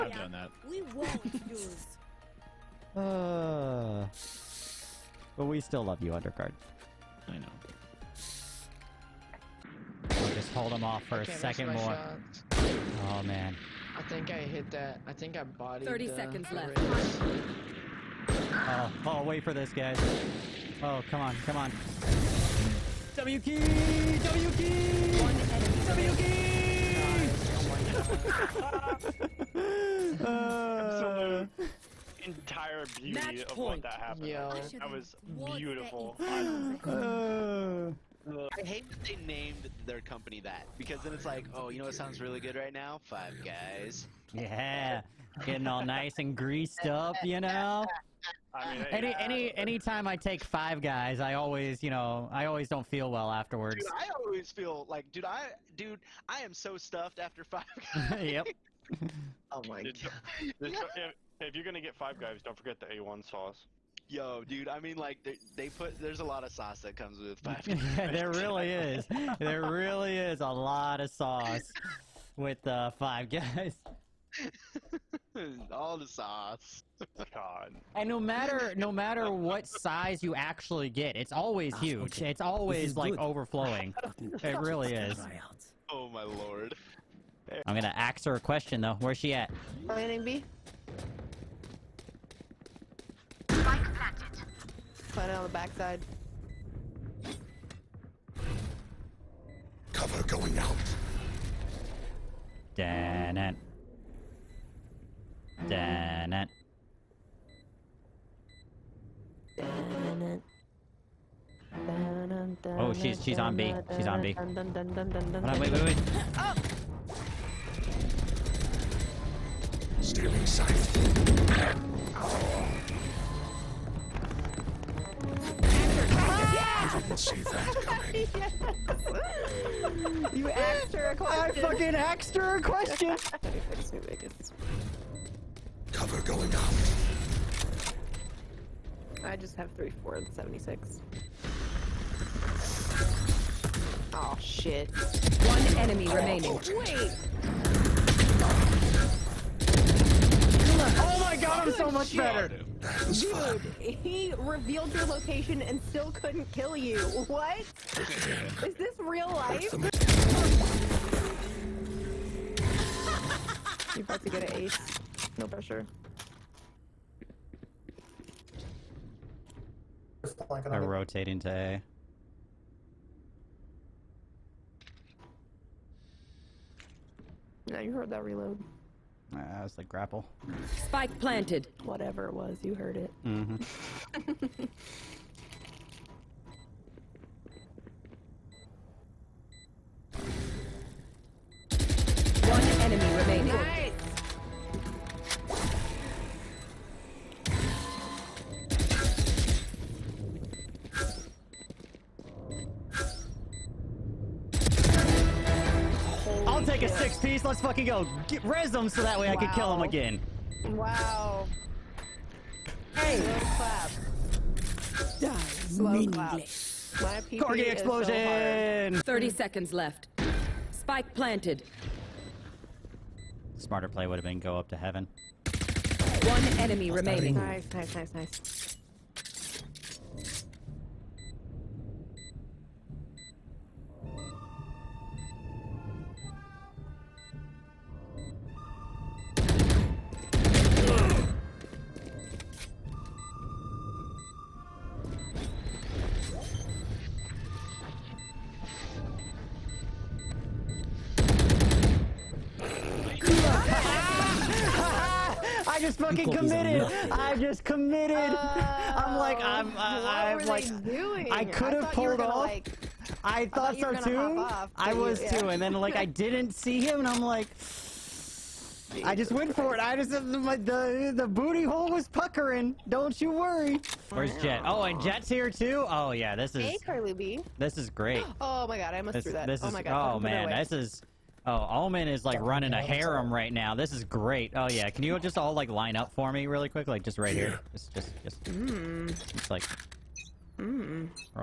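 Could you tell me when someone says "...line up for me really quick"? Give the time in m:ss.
4:45.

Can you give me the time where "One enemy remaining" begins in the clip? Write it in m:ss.
3:46.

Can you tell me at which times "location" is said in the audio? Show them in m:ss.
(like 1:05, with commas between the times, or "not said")
2:35.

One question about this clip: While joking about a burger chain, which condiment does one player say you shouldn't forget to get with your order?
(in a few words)
A1 sauce.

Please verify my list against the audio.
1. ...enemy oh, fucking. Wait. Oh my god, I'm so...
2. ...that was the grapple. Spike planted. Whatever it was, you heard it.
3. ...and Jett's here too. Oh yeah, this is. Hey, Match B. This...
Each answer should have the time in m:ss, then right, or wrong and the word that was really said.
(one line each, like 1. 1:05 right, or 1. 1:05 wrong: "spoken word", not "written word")
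1. 2:25 wrong: "remaining", not "fucking"
2. 2:59 right
3. 4:34 wrong: "Carly", not "Match".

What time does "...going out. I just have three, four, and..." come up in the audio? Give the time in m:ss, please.
2:16.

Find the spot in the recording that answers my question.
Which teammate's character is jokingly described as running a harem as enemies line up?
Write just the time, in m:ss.
4:41.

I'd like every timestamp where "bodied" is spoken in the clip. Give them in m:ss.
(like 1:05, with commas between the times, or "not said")
0:15.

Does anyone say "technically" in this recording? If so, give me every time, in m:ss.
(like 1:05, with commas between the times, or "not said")
not said.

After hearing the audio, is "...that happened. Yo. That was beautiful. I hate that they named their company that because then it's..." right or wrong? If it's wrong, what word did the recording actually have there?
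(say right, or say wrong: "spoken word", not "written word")
right.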